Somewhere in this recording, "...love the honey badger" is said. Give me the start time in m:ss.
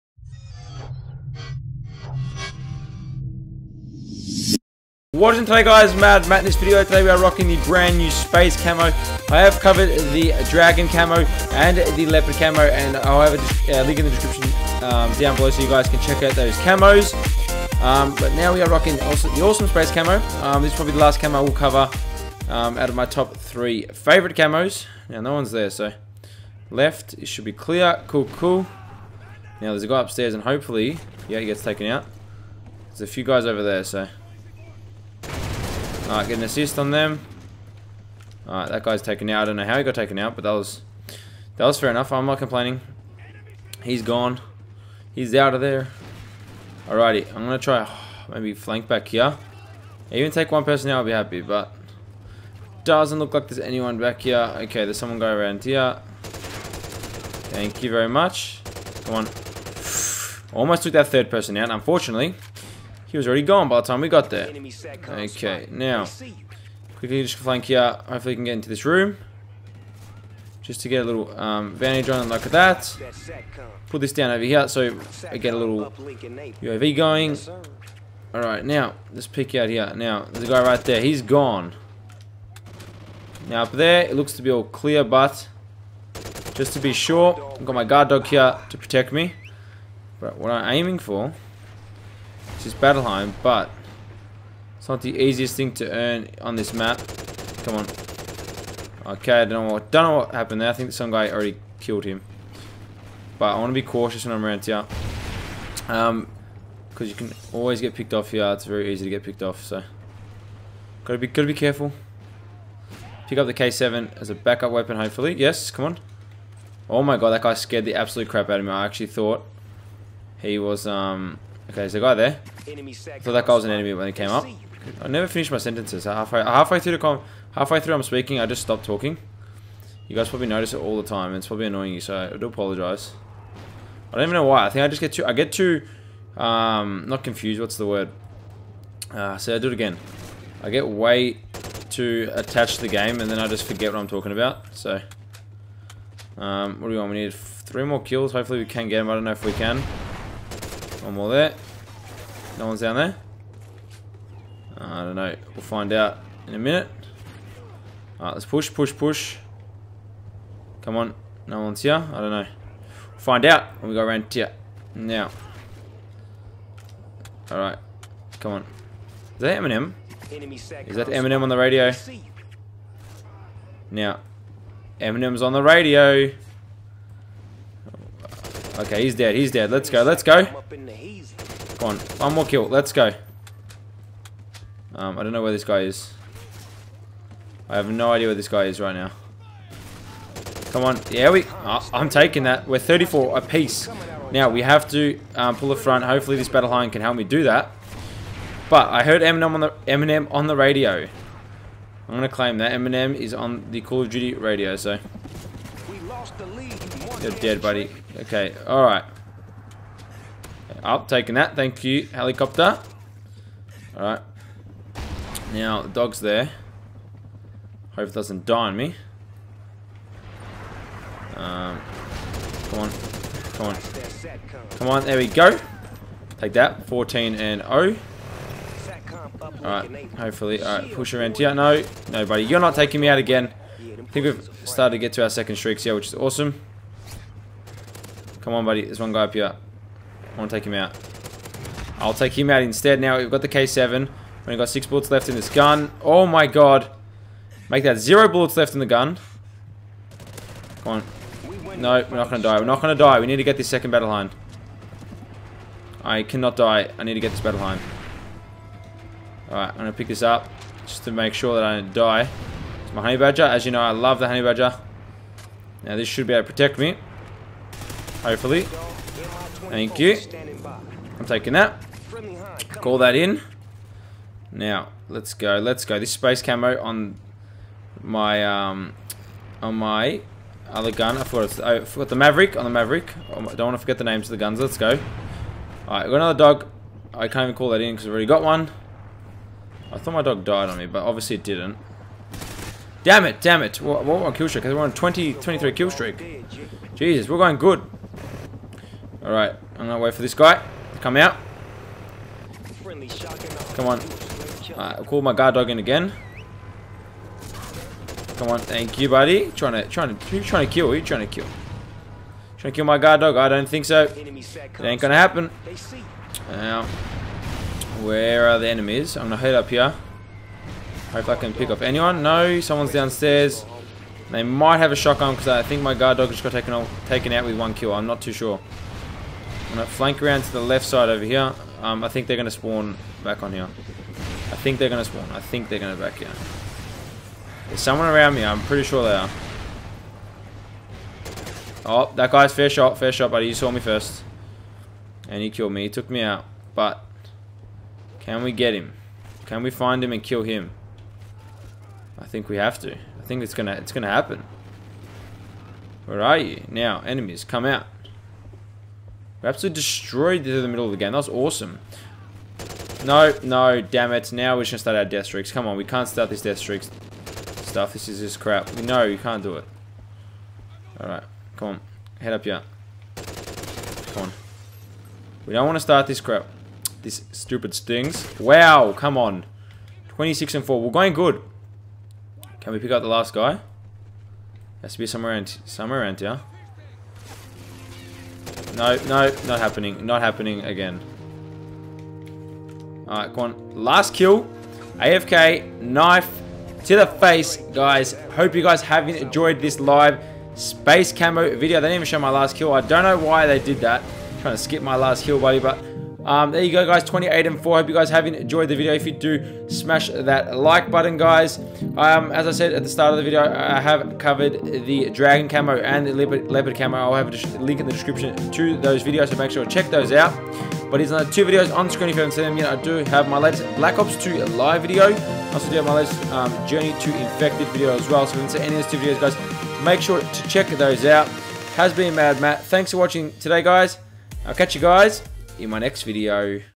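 4:23.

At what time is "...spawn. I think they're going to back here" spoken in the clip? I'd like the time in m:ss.
5:35.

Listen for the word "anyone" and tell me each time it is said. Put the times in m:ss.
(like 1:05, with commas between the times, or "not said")
0:53, 5:21.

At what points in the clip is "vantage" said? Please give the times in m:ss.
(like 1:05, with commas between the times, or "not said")
1:11.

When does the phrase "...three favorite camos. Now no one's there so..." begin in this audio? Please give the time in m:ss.
0:23.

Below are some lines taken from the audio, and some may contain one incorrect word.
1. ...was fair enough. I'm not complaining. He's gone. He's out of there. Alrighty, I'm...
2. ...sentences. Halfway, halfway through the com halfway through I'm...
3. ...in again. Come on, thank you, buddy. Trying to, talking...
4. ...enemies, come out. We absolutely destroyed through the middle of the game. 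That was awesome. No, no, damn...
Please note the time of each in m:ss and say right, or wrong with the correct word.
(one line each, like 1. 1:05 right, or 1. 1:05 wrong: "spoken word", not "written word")
1. 0:41 right
2. 2:05 right
3. 5:05 wrong: "trying", not "talking"
4. 5:57 right.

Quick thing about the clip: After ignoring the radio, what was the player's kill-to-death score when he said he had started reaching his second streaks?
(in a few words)
14 and 0.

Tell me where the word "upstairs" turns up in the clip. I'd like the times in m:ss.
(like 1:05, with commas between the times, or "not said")
0:30.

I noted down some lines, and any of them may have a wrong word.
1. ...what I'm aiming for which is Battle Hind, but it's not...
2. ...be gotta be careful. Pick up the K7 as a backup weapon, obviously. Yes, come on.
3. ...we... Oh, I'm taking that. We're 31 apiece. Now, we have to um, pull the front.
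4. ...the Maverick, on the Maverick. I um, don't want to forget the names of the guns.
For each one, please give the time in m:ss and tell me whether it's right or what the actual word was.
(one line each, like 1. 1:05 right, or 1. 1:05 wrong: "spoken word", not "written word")
1. 1:30 right
2. 1:51 wrong: "hopefully", not "obviously"
3. 3:11 wrong: "34", not "31"
4. 4:42 right.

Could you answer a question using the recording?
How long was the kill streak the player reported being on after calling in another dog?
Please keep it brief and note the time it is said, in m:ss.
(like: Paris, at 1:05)
23, at 4:55.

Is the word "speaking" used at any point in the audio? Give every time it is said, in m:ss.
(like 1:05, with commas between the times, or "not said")
2:08.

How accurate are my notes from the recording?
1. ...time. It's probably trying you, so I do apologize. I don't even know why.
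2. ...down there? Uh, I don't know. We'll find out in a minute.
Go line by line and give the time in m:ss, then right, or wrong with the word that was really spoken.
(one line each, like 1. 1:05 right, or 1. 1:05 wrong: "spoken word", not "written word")
1. 2:11 wrong: "annoying", not "trying"
2. 2:32 right.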